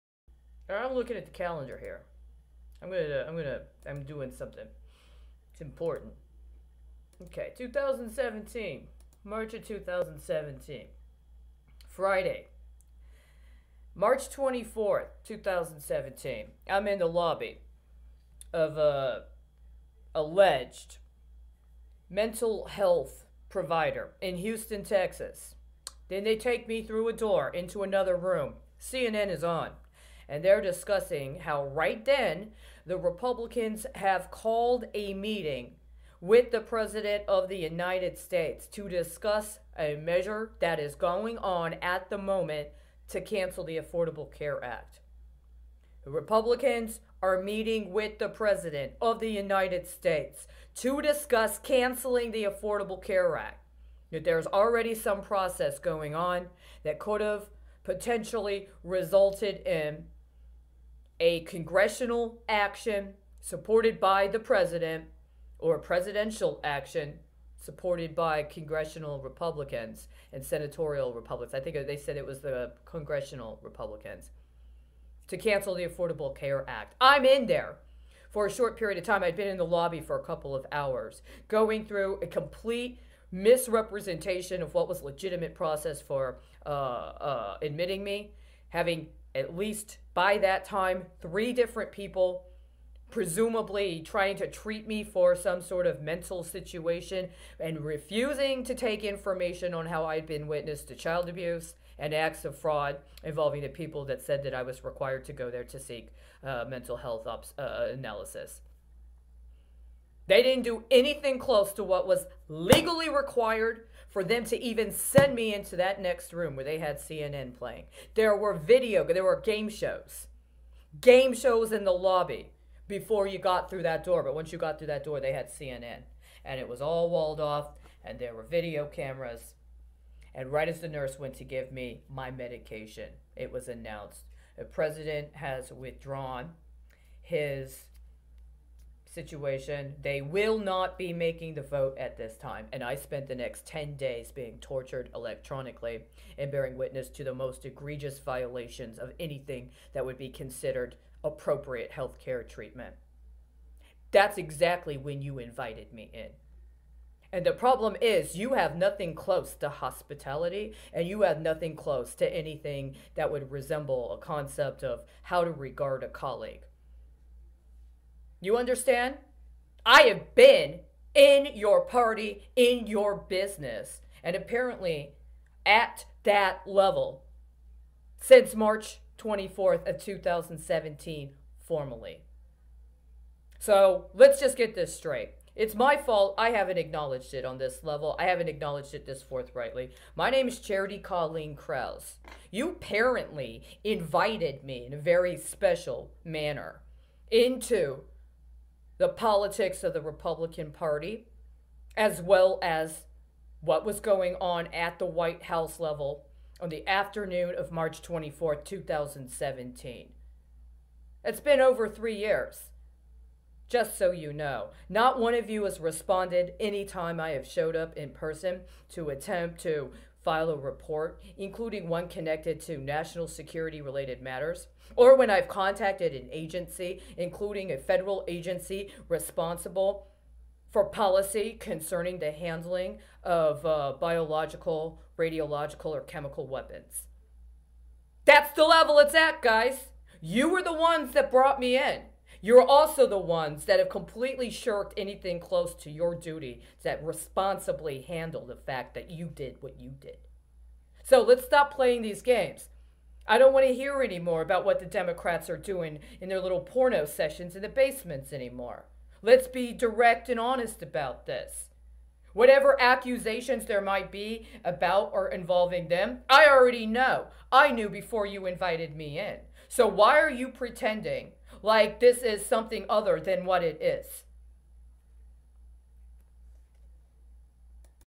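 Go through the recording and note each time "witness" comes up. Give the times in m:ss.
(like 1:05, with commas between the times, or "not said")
1:40, 2:26.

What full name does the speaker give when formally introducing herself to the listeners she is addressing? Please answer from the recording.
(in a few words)
Charity Colleen Crouse.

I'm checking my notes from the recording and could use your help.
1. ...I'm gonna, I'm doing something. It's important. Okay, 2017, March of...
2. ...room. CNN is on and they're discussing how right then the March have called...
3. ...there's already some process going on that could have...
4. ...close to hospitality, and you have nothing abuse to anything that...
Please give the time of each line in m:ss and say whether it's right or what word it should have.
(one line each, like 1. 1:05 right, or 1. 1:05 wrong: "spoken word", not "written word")
1. 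0:03 right
2. 0:28 wrong: "Republicans", not "March"
3. 0:54 right
4. 2:39 wrong: "close", not "abuse".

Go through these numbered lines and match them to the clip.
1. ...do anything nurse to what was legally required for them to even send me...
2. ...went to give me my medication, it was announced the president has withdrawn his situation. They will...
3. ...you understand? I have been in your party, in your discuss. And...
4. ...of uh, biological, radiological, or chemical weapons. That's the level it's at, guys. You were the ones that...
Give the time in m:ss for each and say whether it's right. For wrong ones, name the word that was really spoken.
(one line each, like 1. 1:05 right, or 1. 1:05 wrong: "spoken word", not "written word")
1. 1:50 wrong: "close", not "nurse"
2. 2:11 right
3. 2:48 wrong: "business", not "discuss"
4. 3:53 right.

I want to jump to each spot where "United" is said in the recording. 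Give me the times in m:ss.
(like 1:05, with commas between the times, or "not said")
0:37, 0:49.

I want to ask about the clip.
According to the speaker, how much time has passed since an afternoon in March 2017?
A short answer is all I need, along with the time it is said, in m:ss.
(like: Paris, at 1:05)
over 3 years, at 3:31.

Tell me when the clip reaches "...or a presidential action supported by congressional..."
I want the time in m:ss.
1:05.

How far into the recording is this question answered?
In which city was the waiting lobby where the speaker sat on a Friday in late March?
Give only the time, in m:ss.
0:24.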